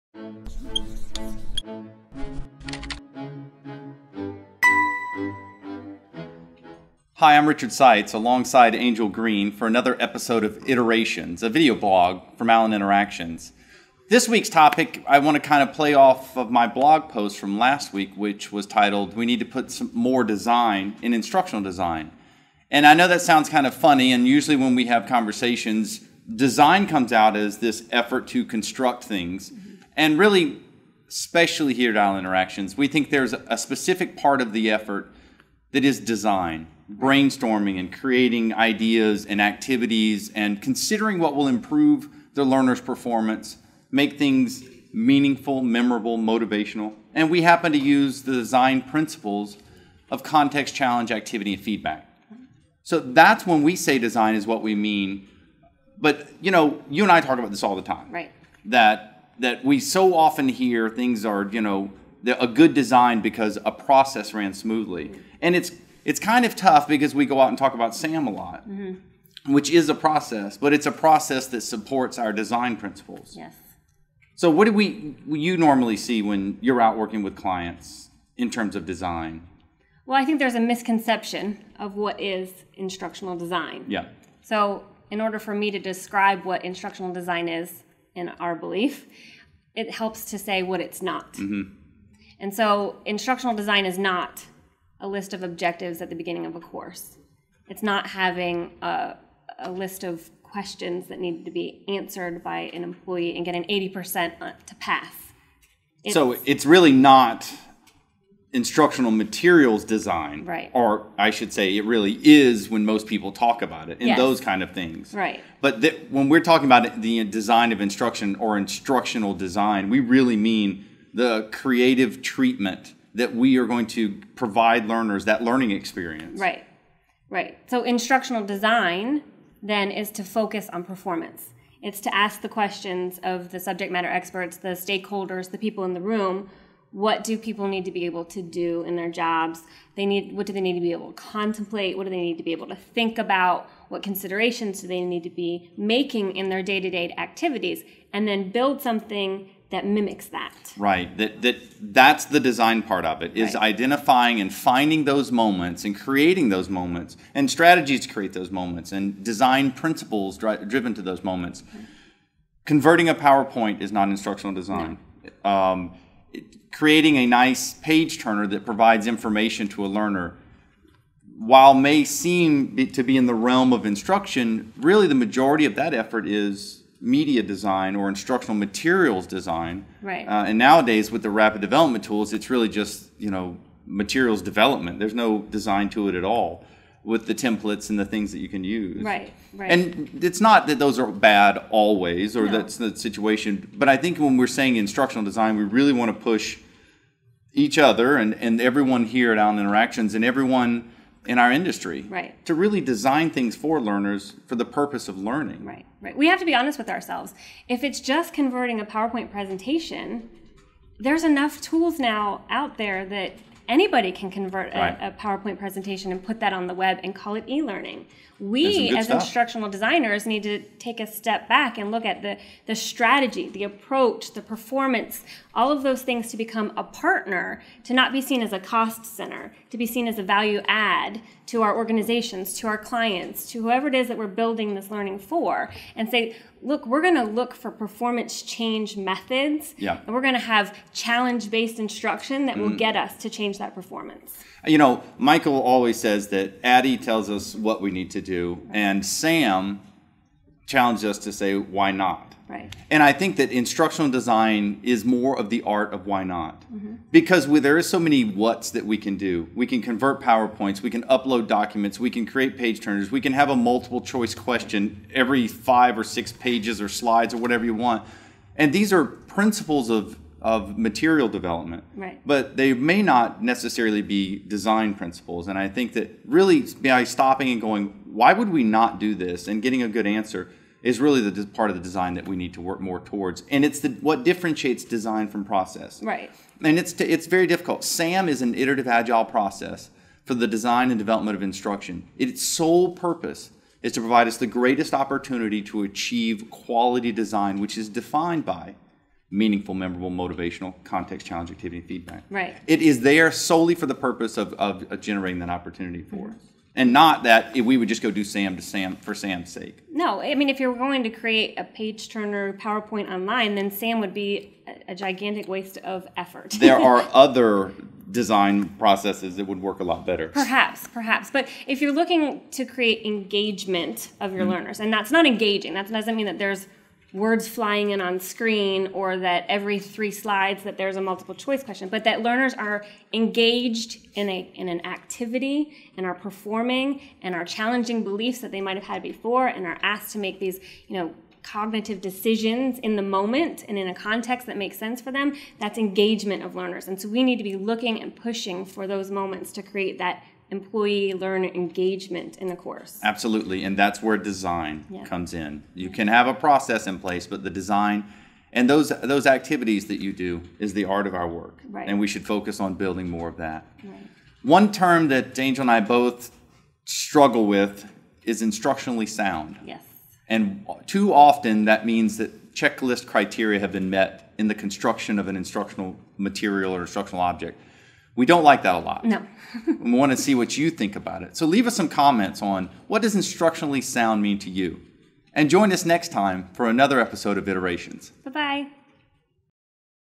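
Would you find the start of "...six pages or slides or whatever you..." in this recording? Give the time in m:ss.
4:26.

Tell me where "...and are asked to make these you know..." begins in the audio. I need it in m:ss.
5:39.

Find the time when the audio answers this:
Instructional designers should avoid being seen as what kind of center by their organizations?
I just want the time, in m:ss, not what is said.
3:48.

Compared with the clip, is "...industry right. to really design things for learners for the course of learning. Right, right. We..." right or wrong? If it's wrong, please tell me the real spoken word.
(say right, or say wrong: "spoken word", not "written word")
wrong: "purpose", not "course".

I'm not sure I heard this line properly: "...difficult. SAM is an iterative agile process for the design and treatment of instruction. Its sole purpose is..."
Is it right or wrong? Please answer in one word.
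wrong.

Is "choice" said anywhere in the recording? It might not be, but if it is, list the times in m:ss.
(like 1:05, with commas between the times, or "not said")
4:24, 5:31.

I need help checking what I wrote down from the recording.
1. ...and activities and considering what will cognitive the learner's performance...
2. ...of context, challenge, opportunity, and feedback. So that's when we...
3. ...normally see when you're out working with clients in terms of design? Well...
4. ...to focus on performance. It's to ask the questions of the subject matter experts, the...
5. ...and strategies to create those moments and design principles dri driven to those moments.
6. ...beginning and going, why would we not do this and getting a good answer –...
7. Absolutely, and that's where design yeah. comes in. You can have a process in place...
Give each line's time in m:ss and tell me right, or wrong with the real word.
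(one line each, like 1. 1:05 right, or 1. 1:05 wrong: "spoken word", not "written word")
1. 0:39 wrong: "improve", not "cognitive"
2. 0:50 wrong: "activity", not "opportunity"
3. 1:15 right
4. 2:10 right
5. 2:37 right
6. 4:37 wrong: "stopping", not "beginning"
7. 5:53 right.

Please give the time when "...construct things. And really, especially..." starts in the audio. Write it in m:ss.
0:28.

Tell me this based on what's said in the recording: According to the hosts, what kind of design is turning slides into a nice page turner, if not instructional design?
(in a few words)
media design.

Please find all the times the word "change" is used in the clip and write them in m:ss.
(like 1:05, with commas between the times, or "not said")
3:58, 4:03.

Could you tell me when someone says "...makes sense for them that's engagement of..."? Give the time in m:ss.
5:44.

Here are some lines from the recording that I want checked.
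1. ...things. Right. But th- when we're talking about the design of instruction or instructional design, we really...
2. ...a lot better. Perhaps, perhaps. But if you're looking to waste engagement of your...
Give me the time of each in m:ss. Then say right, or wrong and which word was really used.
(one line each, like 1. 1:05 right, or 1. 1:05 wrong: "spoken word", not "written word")
1. 1:54 right
2. 5:19 wrong: "create", not "waste".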